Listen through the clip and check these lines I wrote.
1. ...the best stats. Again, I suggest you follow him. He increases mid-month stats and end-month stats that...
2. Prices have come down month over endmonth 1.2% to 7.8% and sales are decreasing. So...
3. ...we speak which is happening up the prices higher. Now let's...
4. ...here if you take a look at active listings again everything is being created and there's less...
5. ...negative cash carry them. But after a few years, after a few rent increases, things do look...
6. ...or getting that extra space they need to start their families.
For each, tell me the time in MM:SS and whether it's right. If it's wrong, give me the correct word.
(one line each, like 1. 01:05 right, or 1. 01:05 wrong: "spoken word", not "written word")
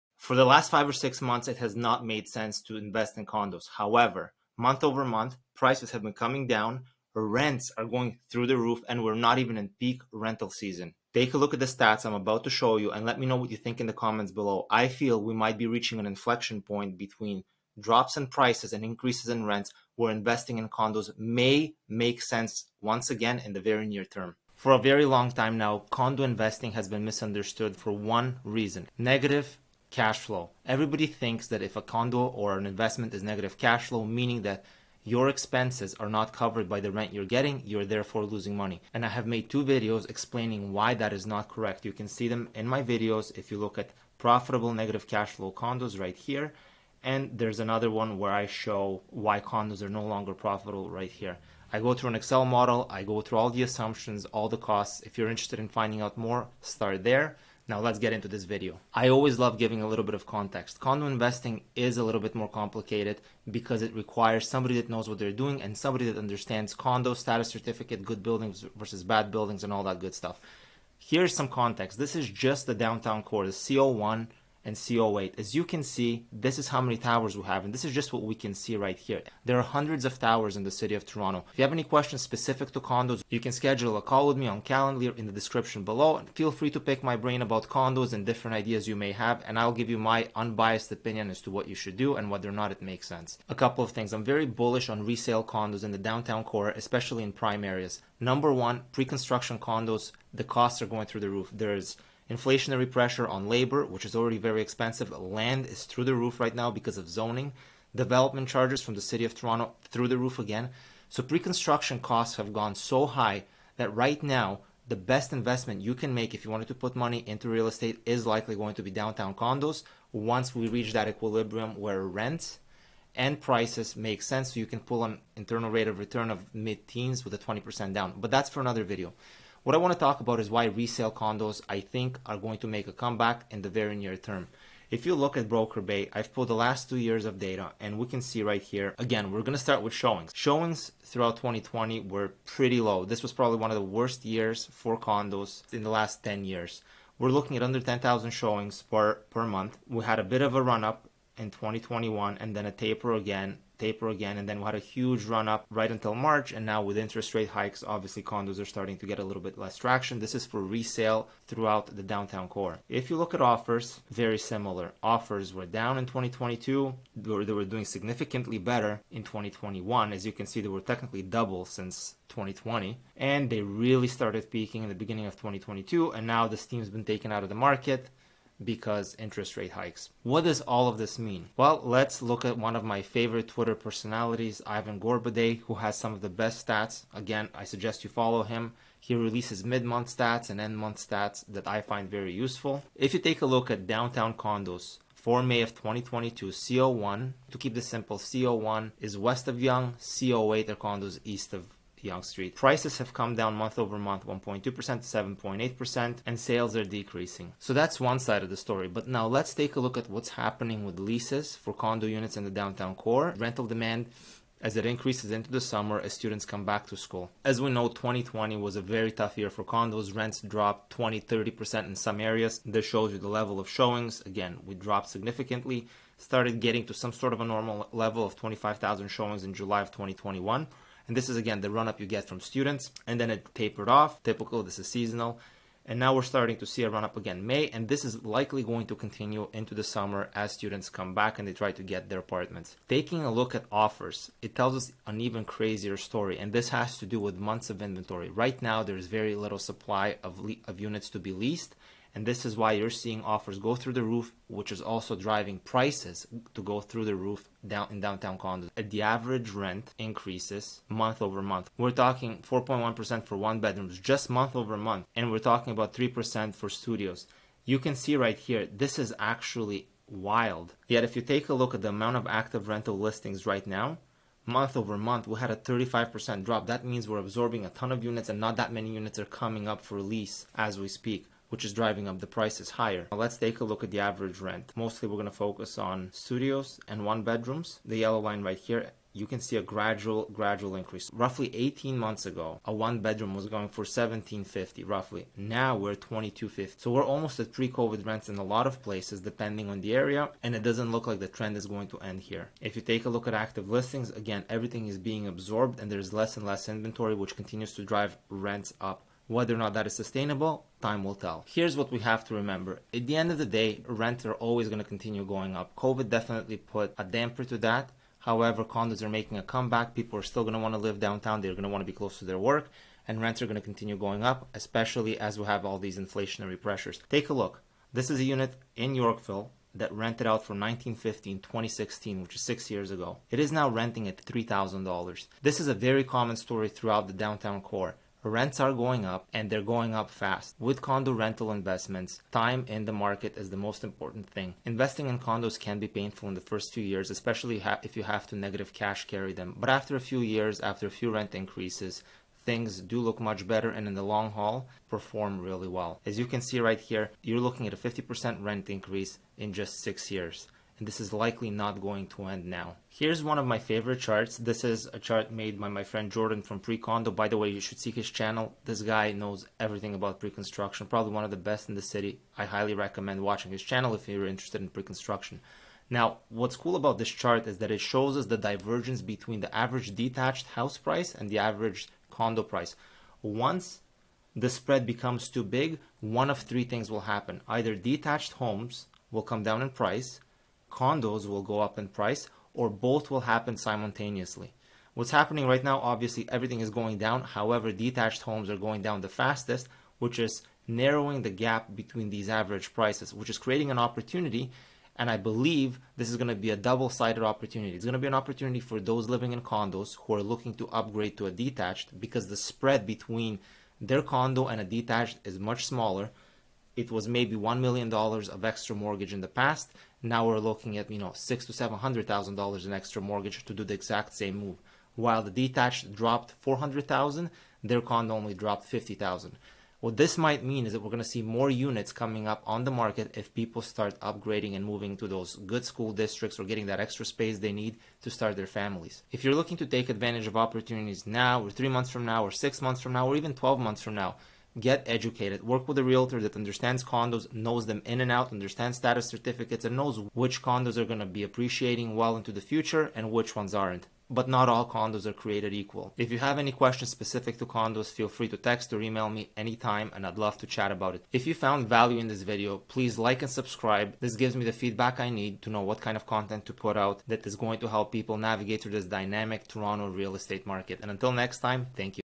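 1. 03:06 wrong: "releases", not "increases"
2. 03:22 wrong: "month", not "endmonth"
3. 04:40 wrong: "driving", not "happening"
4. 05:02 wrong: "absorbed", not "created"
5. 05:48 right
6. 07:16 right.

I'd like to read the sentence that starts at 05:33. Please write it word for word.
It is now renting at $3,000.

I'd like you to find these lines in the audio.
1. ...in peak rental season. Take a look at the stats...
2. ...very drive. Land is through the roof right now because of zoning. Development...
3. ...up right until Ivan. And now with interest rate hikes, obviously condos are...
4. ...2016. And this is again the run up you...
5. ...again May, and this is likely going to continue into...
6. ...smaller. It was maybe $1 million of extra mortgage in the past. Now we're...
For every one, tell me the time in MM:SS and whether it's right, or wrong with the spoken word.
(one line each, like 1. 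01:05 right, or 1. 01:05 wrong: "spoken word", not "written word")
1. 00:09 right
2. 01:44 wrong: "expensive", not "drive"
3. 02:35 wrong: "March", not "Ivan"
4. 03:49 wrong: "2021", not "2016"
5. 03:57 right
6. 06:55 right.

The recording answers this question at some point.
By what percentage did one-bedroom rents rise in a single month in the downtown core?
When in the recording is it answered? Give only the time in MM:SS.
04:22.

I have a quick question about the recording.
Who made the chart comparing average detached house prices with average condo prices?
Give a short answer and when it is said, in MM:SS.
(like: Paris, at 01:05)
Jordan, at 06:06.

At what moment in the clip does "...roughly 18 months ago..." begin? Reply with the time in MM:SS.
04:51.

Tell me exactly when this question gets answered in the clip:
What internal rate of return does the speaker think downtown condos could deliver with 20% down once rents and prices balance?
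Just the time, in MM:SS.
02:06.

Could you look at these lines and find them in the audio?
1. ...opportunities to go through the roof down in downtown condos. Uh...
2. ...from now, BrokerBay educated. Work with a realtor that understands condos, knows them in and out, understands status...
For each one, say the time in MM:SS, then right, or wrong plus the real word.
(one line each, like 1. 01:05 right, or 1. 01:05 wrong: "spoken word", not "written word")
1. 04:15 wrong: "prices", not "opportunities"
2. 07:23 wrong: "Get", not "BrokerBay".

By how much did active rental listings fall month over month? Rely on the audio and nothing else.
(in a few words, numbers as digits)
35%.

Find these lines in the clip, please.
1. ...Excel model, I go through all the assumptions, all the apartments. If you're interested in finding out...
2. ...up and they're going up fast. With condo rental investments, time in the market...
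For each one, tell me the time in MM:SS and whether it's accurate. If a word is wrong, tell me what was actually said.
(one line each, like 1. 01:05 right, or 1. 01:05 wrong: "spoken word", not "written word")
1. 00:52 wrong: "costs", not "apartments"
2. 05:39 right.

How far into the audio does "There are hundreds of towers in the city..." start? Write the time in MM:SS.
01:19.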